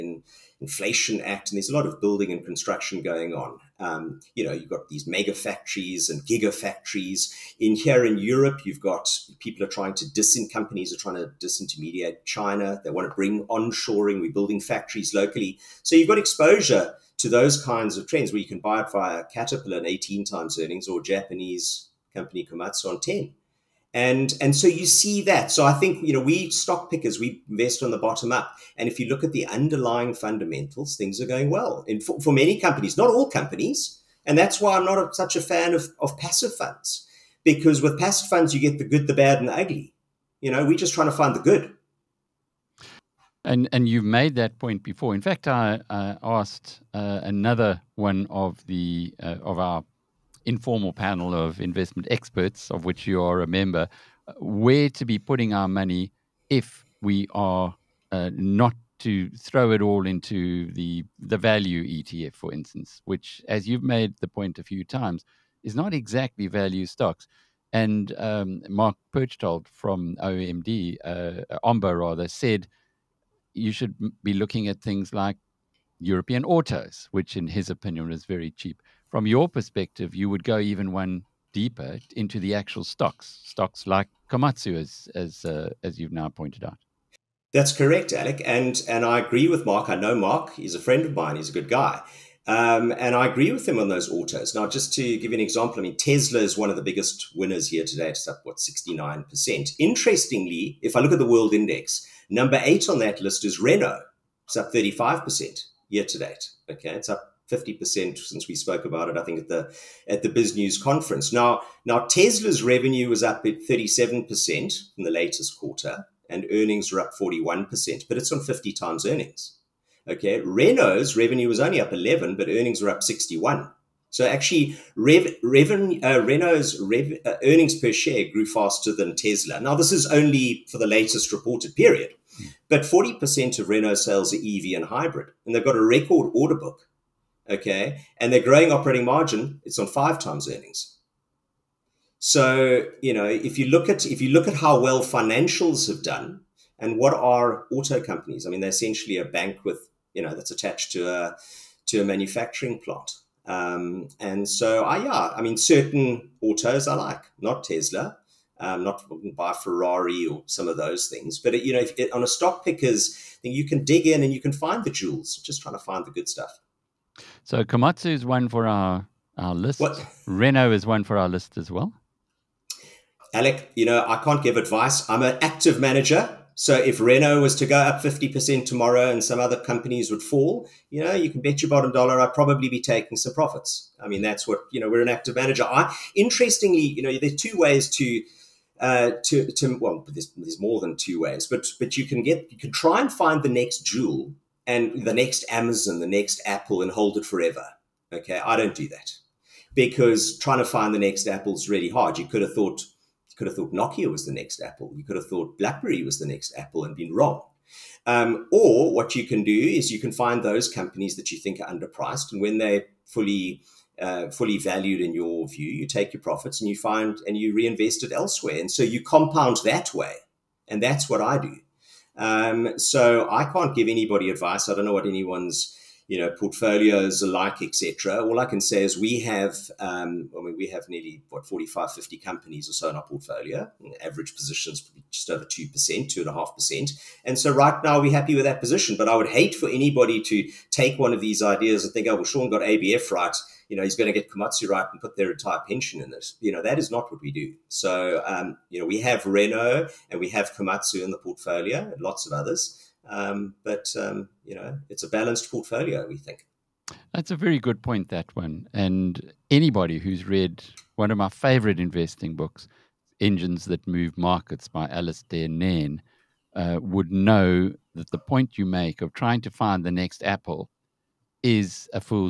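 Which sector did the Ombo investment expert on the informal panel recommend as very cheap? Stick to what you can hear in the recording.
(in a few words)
European autos.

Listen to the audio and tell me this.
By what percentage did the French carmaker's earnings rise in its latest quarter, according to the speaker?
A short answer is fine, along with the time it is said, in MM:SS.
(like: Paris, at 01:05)
61%, at 02:03.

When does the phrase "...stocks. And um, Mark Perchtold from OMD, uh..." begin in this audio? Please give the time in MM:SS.
01:06.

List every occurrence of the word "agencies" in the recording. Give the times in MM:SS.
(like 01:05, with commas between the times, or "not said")
not said.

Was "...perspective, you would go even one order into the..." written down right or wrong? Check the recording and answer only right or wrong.
wrong.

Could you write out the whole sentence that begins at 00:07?
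In here in Europe, you've got people are trying to disin companies are trying to disintermediate China.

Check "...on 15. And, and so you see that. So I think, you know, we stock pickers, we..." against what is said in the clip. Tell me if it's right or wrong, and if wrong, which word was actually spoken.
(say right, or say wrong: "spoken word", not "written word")
wrong: "10", not "15".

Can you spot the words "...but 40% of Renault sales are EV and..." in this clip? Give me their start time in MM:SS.
02:12.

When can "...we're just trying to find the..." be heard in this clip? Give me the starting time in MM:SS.
00:40.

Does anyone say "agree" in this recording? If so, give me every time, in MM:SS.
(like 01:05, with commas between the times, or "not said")
01:29, 01:33.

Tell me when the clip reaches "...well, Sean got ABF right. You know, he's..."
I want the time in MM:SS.
04:02.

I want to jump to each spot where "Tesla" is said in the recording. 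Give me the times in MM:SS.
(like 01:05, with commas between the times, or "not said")
01:35, 01:52, 02:09, 02:37.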